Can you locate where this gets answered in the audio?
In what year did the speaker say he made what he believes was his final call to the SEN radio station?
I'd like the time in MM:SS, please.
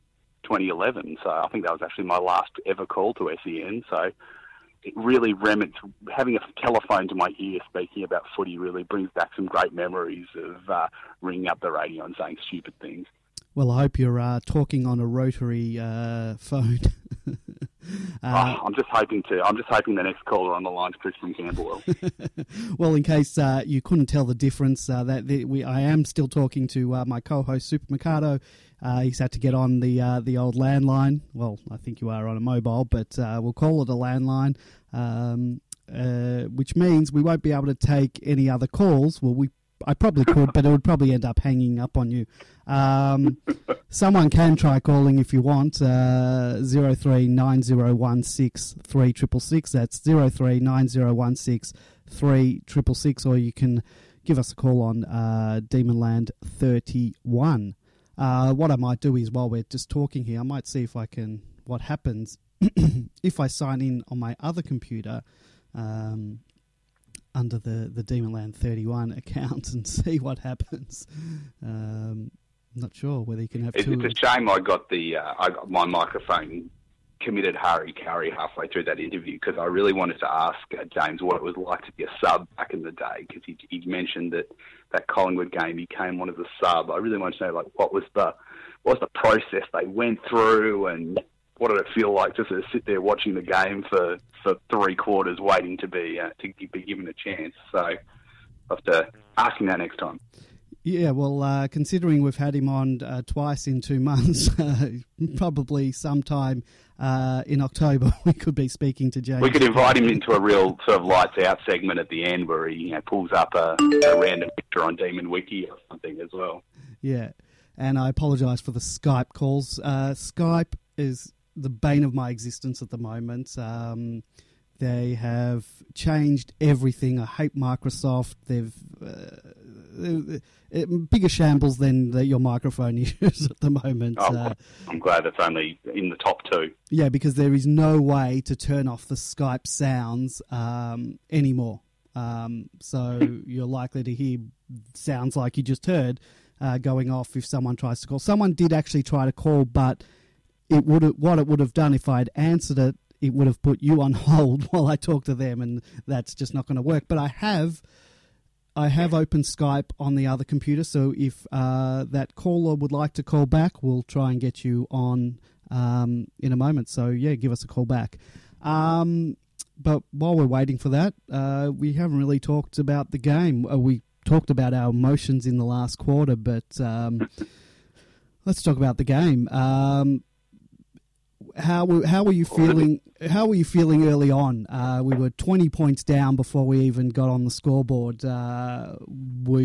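00:00.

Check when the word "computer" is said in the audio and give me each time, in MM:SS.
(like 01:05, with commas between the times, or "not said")
01:04, 02:40.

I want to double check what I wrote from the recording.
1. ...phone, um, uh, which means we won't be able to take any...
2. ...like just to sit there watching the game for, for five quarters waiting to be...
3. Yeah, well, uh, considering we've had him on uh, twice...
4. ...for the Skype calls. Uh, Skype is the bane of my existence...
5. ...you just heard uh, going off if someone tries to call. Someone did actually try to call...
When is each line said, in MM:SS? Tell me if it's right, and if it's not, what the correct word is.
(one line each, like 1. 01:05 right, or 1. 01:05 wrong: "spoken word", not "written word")
1. 00:33 wrong: "landline", not "phone"
2. 01:32 wrong: "three", not "five"
3. 01:40 right
4. 01:58 right
5. 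02:25 right.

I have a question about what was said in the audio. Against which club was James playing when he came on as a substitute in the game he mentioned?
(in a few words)
Collingwood.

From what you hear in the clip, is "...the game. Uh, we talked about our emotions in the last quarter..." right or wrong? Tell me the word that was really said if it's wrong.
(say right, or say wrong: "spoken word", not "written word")
right.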